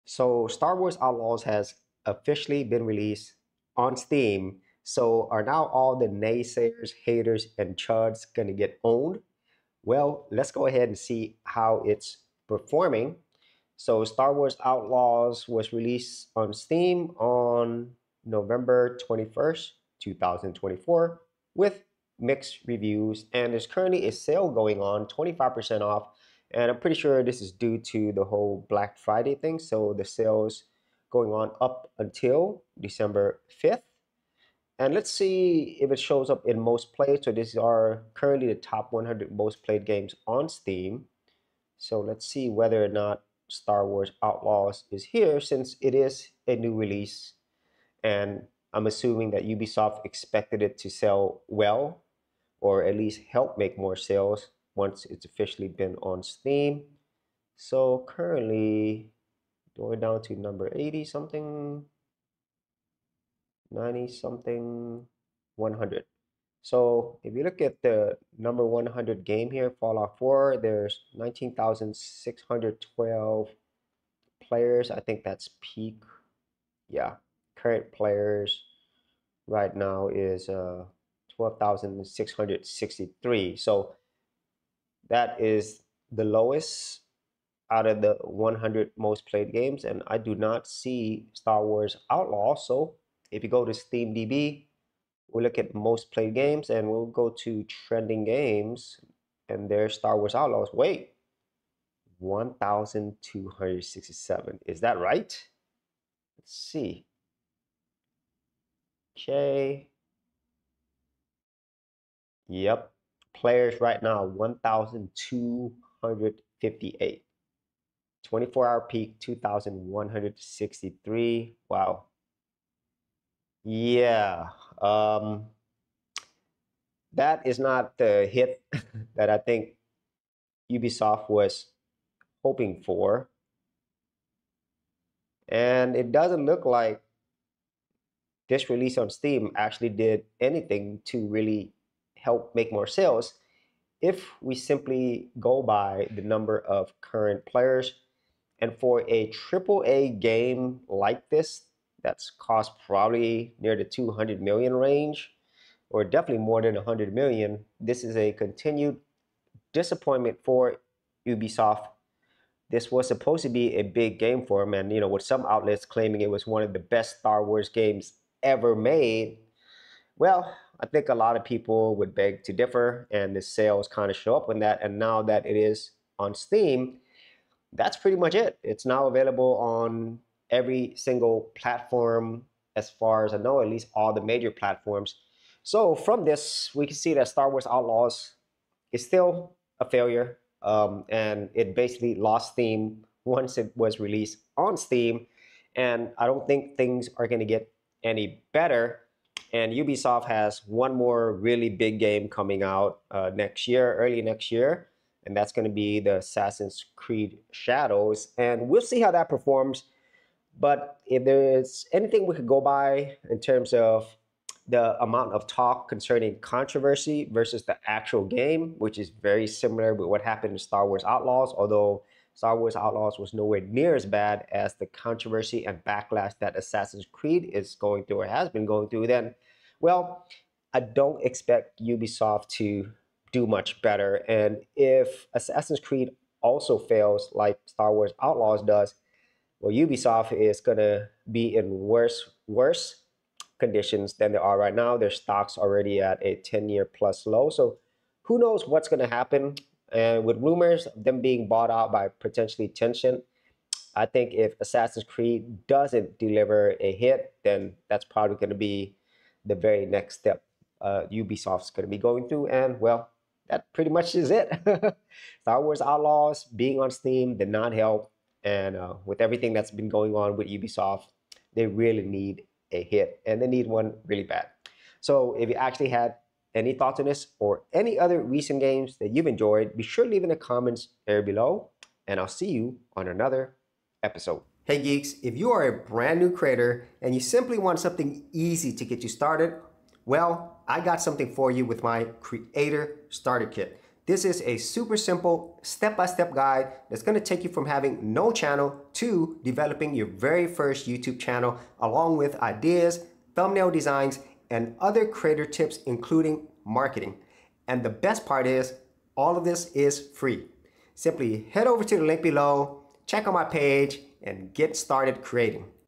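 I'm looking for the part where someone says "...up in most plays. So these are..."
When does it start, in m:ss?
0:36.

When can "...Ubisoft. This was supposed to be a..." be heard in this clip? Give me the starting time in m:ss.
2:41.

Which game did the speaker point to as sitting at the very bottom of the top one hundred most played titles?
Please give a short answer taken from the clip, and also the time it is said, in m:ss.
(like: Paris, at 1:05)
Fallout 4, at 1:09.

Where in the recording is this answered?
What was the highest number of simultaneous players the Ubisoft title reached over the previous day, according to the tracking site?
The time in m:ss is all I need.
1:59.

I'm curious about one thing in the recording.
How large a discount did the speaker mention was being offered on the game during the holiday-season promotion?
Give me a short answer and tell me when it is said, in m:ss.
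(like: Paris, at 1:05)
25%, at 0:25.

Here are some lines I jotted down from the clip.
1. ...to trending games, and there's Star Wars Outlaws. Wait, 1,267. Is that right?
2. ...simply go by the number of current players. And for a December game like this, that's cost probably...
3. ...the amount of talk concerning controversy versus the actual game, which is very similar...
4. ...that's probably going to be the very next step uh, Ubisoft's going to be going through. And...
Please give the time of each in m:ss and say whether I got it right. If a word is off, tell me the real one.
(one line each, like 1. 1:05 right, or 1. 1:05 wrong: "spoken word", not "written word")
1. 1:37 right
2. 2:24 wrong: "AAA", not "December"
3. 3:34 right
4. 4:17 right.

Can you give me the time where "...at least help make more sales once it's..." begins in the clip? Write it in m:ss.
0:52.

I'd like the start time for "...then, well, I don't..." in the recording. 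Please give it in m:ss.
3:49.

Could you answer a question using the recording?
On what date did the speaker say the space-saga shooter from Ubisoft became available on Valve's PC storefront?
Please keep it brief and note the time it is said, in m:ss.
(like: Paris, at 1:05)
November 21st, 2024, at 0:18.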